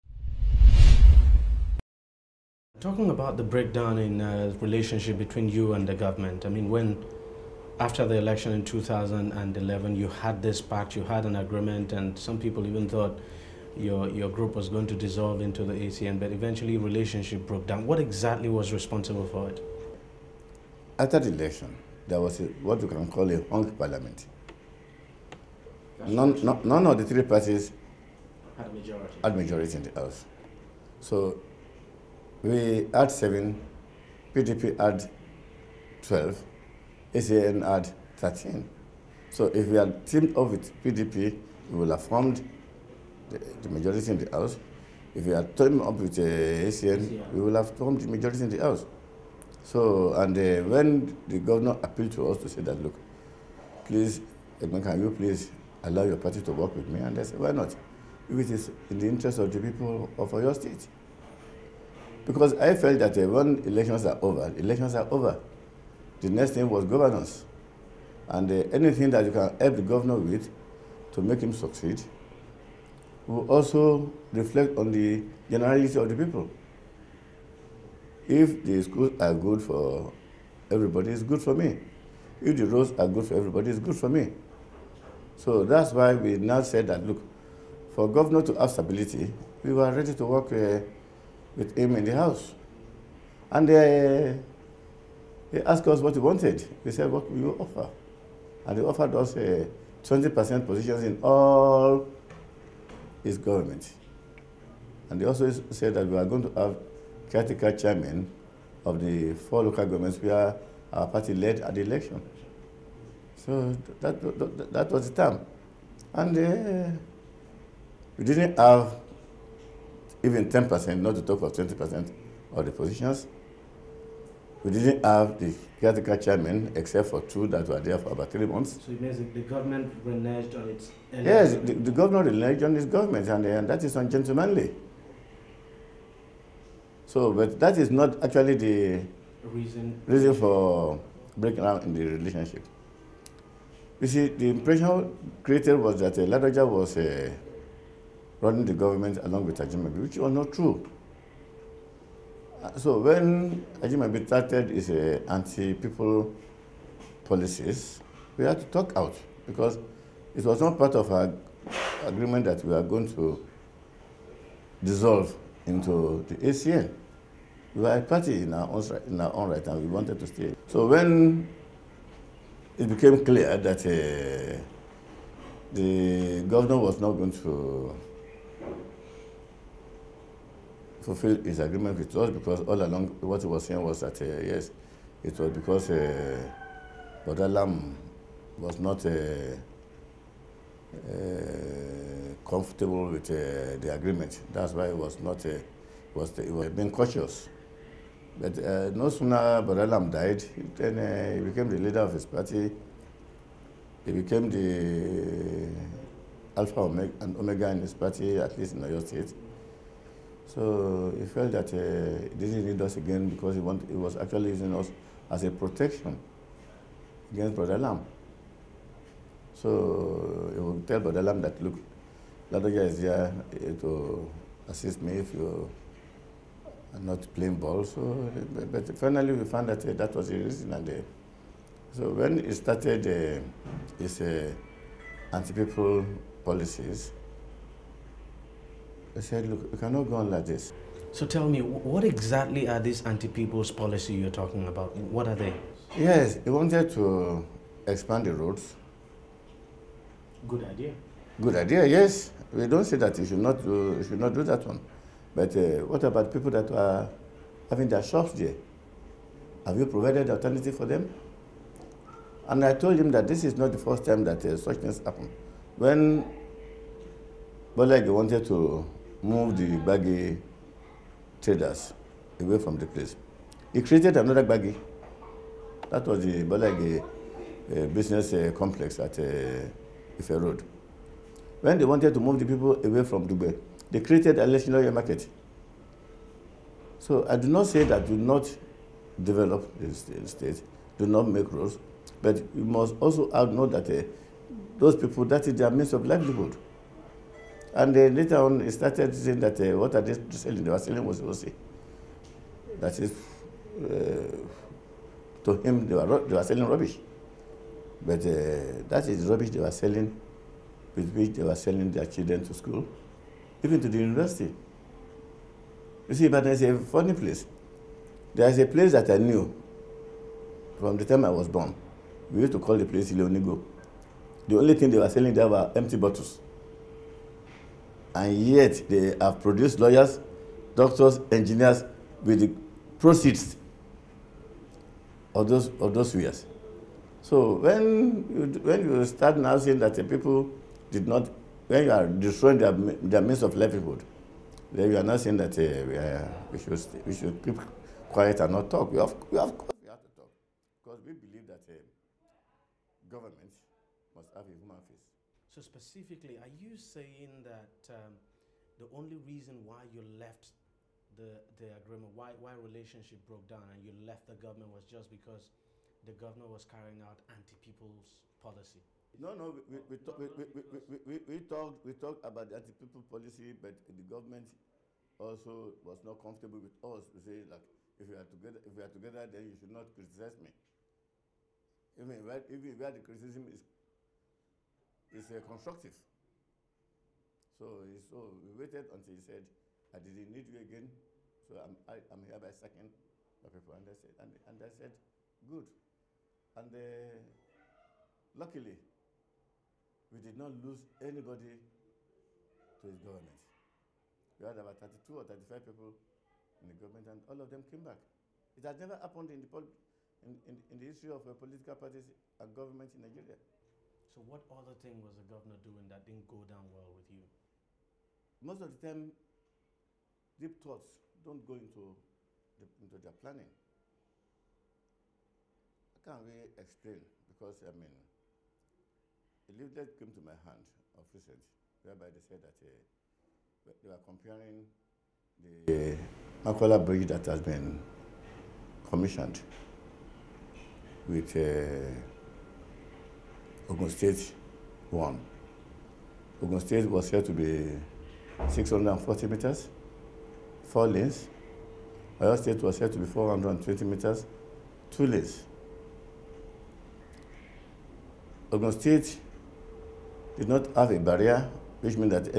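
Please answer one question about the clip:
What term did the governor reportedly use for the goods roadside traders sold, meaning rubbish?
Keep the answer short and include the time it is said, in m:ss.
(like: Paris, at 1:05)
Wosiwosi, at 5:01.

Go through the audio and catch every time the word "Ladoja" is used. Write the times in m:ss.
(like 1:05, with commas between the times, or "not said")
2:26, 3:42.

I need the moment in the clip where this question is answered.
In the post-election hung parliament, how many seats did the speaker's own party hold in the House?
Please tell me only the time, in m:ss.
0:33.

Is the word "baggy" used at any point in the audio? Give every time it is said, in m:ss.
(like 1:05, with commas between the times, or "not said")
4:29, 4:34.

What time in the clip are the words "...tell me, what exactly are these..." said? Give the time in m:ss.
4:01.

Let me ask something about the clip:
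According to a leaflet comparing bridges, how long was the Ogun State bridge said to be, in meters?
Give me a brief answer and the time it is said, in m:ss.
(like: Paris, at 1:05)
640 meters, at 7:28.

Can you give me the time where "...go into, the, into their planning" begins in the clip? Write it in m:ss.
7:01.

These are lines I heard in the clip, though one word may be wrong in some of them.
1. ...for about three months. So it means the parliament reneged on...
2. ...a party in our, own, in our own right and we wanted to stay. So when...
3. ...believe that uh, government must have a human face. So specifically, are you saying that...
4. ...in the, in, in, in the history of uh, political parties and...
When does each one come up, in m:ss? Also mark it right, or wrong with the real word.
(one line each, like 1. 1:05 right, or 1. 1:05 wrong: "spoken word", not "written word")
1. 2:07 wrong: "government", not "parliament"
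2. 2:47 right
3. 5:51 right
4. 6:49 right.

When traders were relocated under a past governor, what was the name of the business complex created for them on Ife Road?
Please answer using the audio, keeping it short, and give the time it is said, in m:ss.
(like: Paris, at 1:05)
Balagi, at 4:36.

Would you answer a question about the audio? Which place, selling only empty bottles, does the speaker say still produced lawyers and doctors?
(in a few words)
Leonigo.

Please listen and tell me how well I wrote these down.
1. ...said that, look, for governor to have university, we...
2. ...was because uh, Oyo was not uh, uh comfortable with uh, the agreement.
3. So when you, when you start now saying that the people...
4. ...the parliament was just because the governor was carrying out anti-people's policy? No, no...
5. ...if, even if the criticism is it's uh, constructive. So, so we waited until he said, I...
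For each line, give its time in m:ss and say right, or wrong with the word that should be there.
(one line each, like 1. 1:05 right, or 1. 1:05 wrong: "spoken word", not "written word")
1. 1:26 wrong: "stability", not "university"
2. 3:05 wrong: "Lam", not "Oyo"
3. 5:37 right
4. 6:04 wrong: "government", not "parliament"
5. 6:22 right.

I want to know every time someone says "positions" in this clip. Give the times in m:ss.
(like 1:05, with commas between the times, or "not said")
1:40, 2:02.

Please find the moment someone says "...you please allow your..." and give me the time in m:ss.
0:55.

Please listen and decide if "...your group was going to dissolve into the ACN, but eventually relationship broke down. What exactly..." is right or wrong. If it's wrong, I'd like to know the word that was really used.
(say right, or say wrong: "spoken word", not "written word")
right.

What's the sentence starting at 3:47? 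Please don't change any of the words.
So, but finally we found that uh, that was the reason.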